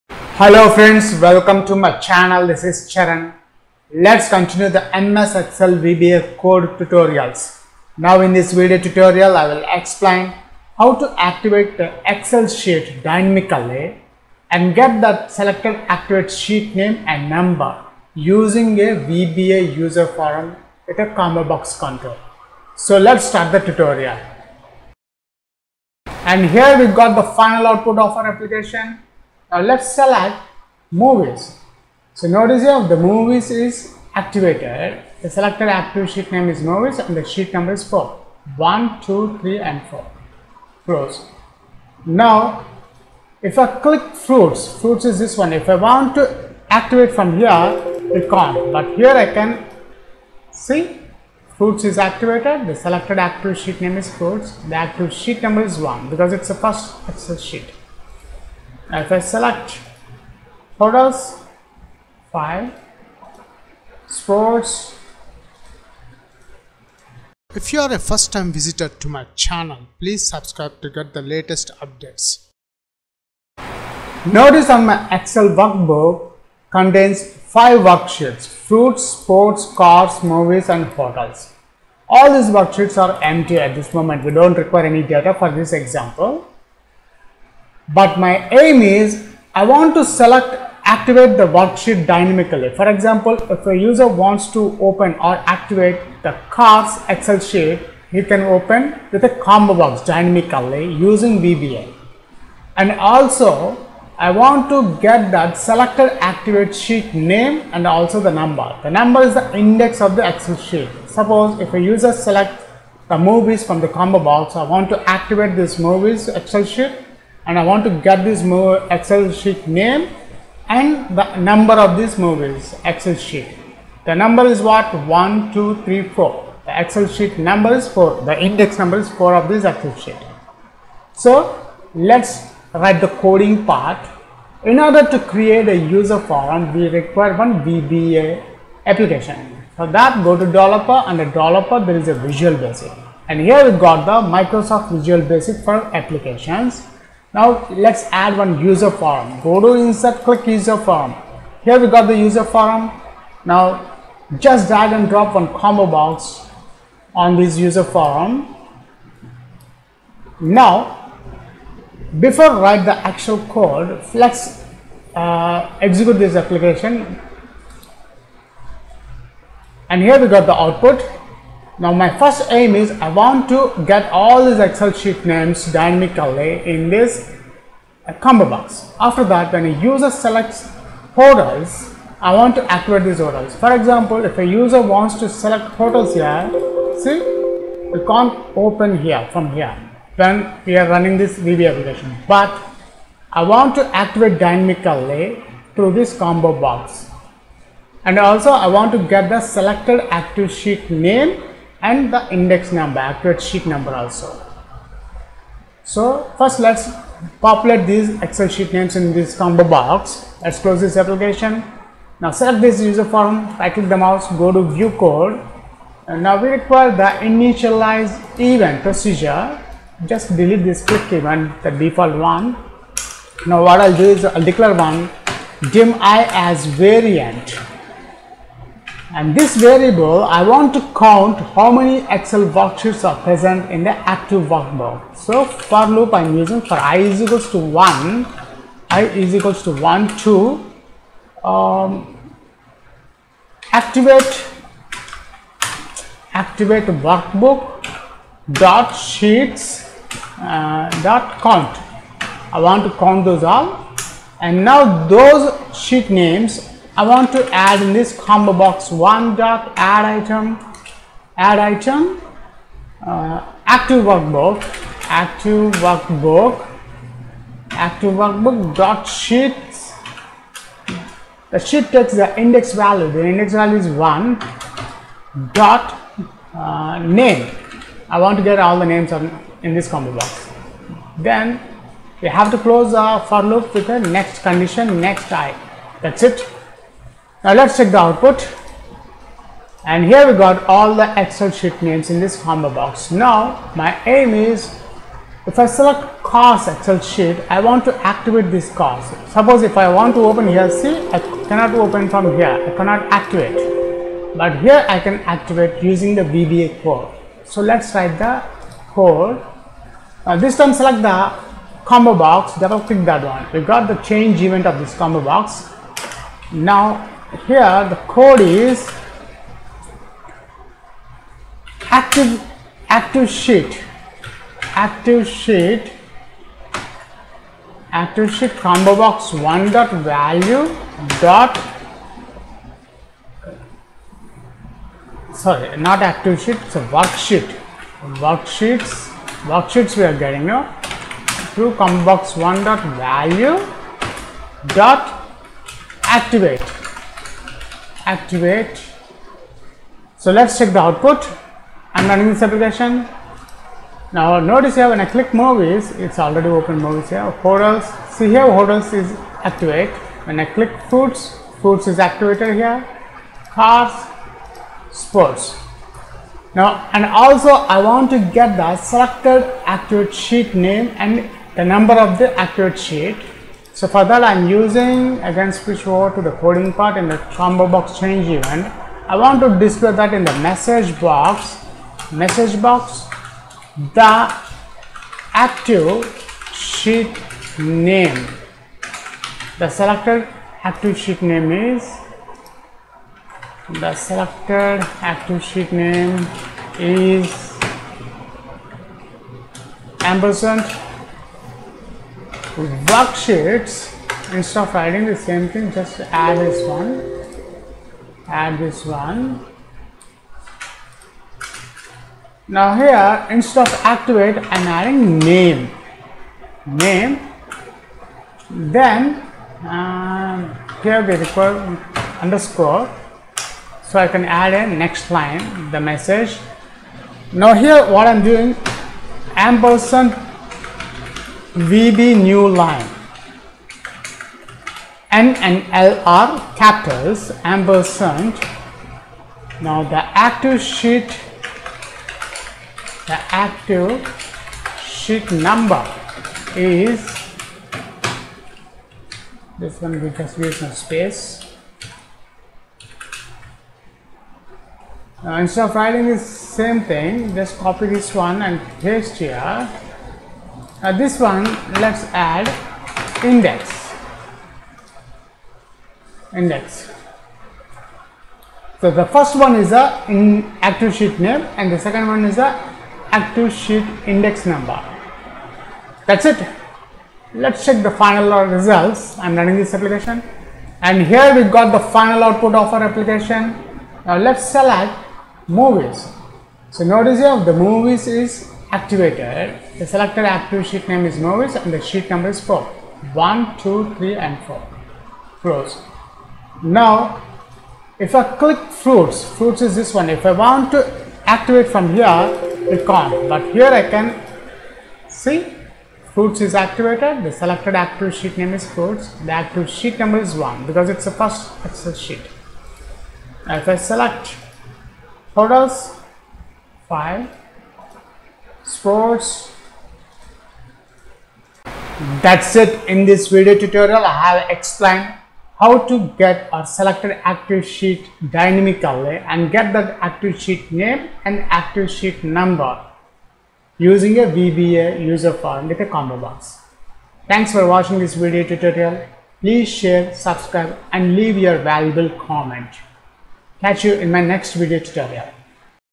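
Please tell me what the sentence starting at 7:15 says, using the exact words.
N and L are capitals ampersand.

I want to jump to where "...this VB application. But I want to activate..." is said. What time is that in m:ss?
3:11.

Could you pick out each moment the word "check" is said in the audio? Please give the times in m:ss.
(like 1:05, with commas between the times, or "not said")
4:47, 5:50, 7:57.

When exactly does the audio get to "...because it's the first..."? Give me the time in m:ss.
8:30.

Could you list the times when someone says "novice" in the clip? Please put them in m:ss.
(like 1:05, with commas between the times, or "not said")
8:11.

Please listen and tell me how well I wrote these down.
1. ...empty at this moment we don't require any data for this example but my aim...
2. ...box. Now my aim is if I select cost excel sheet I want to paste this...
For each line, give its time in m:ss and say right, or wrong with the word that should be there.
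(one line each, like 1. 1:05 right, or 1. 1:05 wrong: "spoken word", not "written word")
1. 1:23 right
2. 4:52 wrong: "activate", not "paste".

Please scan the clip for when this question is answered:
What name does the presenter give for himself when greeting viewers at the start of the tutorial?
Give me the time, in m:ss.
0:02.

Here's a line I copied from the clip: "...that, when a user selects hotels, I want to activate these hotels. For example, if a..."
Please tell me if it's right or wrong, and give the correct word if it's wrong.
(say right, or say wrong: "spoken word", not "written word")
right.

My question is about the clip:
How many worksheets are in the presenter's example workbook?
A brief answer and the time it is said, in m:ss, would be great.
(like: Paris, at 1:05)
five, at 1:17.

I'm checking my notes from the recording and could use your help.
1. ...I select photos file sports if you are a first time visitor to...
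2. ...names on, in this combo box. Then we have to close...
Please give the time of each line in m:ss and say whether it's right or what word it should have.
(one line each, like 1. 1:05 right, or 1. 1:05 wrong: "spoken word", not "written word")
1. 0:59 right
2. 4:38 right.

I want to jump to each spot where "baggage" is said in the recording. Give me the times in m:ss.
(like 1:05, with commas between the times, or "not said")
not said.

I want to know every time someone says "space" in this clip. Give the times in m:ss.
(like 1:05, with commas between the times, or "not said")
7:30.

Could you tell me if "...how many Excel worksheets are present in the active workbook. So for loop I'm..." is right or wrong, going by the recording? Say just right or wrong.
right.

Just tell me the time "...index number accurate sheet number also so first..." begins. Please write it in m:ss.
3:22.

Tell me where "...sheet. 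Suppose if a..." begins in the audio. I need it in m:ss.
1:50.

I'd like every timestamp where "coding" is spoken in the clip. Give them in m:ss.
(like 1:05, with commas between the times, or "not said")
2:13, 6:16.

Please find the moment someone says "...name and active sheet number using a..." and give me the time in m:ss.
8:50.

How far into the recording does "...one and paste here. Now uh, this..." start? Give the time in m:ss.
7:38.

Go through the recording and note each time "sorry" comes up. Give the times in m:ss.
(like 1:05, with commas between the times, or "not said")
5:35.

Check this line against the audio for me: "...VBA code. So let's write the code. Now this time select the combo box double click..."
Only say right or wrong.
right.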